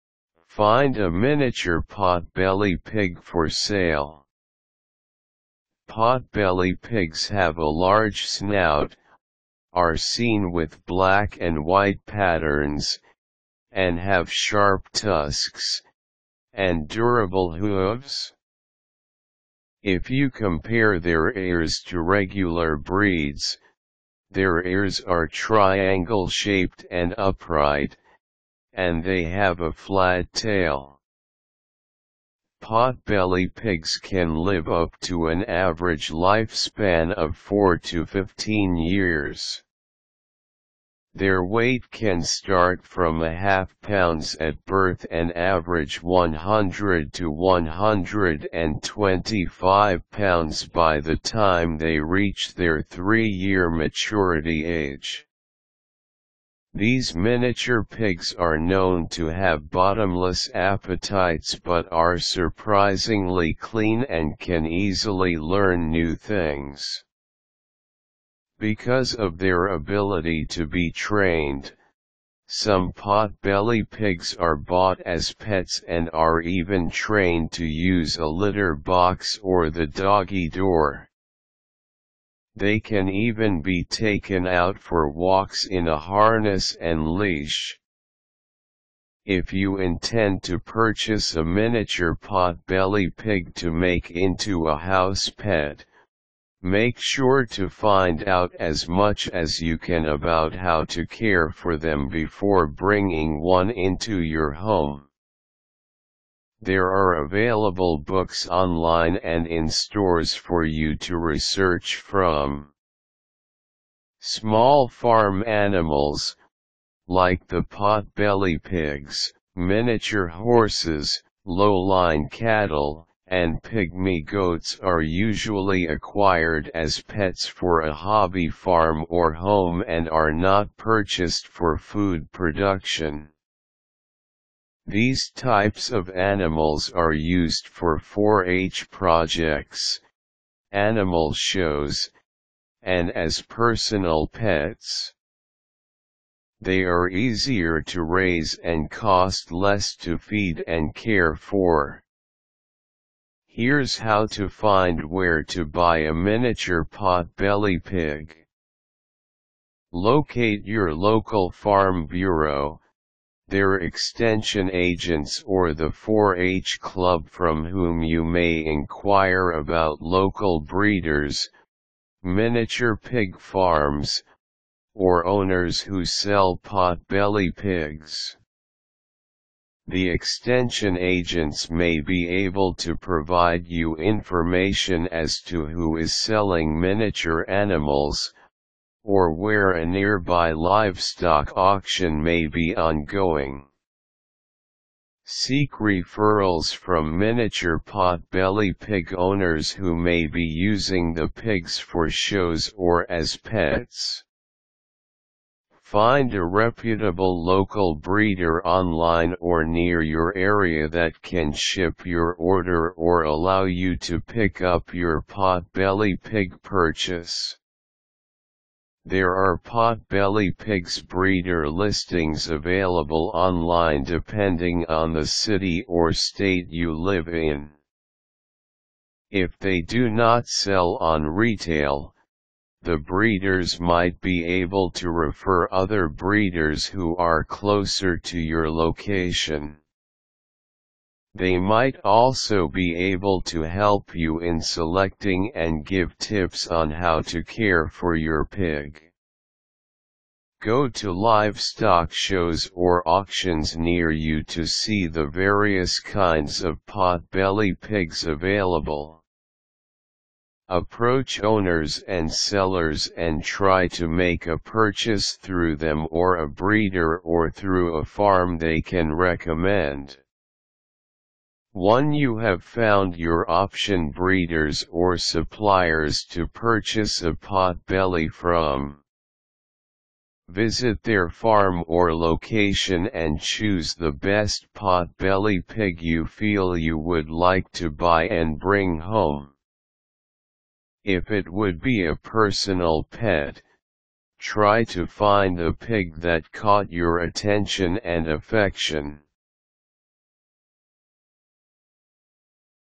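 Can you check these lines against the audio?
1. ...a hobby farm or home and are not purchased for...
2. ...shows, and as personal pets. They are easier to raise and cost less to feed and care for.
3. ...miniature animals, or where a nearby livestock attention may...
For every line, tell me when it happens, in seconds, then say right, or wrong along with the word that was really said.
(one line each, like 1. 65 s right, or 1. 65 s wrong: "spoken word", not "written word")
1. 127 s right
2. 141 s right
3. 186 s wrong: "auction", not "attention".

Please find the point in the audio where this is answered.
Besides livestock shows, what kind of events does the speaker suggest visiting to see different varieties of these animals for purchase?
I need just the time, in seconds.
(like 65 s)
253 s.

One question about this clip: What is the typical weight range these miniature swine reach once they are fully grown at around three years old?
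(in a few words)
100 to 125 pounds.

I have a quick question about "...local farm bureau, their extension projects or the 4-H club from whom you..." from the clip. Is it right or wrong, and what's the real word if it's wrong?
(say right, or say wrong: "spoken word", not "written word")
wrong: "agents", not "projects".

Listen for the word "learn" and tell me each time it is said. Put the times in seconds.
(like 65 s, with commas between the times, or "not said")
65 s.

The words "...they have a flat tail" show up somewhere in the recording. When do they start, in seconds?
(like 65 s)
29 s.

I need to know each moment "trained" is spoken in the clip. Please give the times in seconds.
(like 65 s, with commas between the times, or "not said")
70 s, 76 s.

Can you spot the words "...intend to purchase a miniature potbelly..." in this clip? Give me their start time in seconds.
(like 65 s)
89 s.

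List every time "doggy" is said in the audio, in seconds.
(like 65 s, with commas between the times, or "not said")
79 s.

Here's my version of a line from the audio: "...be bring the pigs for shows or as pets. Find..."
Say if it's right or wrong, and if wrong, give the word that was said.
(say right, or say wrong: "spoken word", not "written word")
wrong: "using", not "bring".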